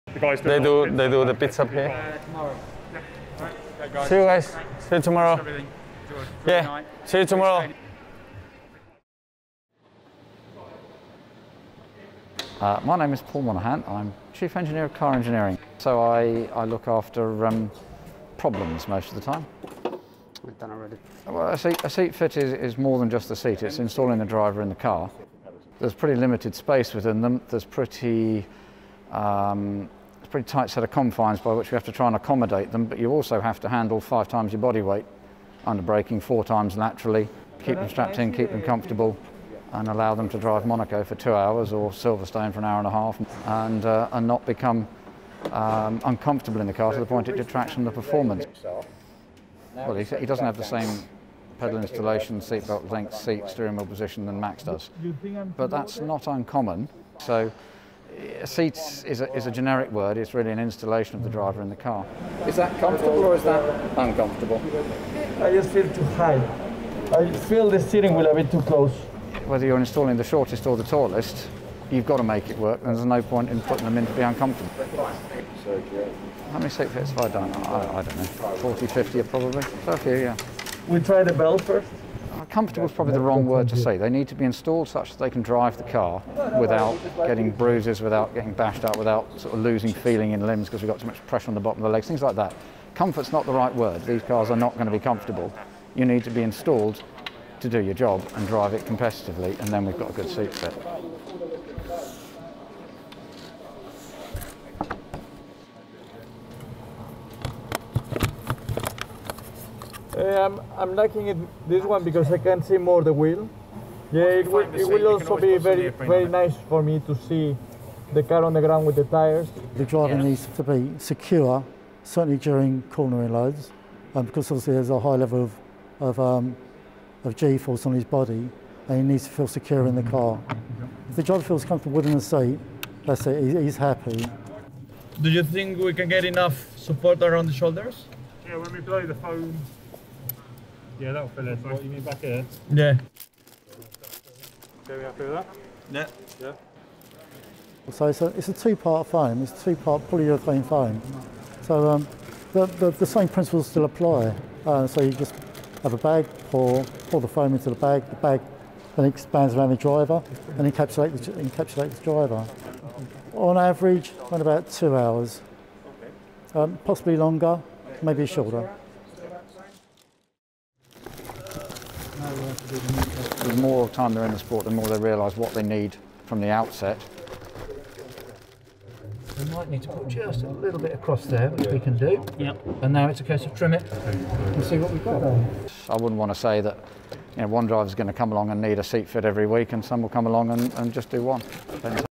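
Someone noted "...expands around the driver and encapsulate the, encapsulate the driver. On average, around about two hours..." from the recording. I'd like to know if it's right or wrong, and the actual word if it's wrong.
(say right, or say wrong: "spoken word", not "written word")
right.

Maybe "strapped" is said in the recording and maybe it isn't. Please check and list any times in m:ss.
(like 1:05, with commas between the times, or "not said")
0:37.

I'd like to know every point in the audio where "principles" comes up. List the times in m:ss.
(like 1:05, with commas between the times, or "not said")
2:33.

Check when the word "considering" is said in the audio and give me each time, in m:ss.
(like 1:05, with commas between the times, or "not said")
not said.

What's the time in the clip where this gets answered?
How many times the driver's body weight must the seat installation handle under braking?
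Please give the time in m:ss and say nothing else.
0:33.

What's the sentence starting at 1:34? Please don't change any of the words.
These cars are not going to be comfortable.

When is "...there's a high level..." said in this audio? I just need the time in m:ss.
2:04.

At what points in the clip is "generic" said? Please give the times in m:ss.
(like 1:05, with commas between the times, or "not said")
0:59.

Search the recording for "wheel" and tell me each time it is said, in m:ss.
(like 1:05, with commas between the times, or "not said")
0:53, 1:08, 1:53.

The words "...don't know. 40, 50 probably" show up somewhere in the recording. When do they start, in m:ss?
1:18.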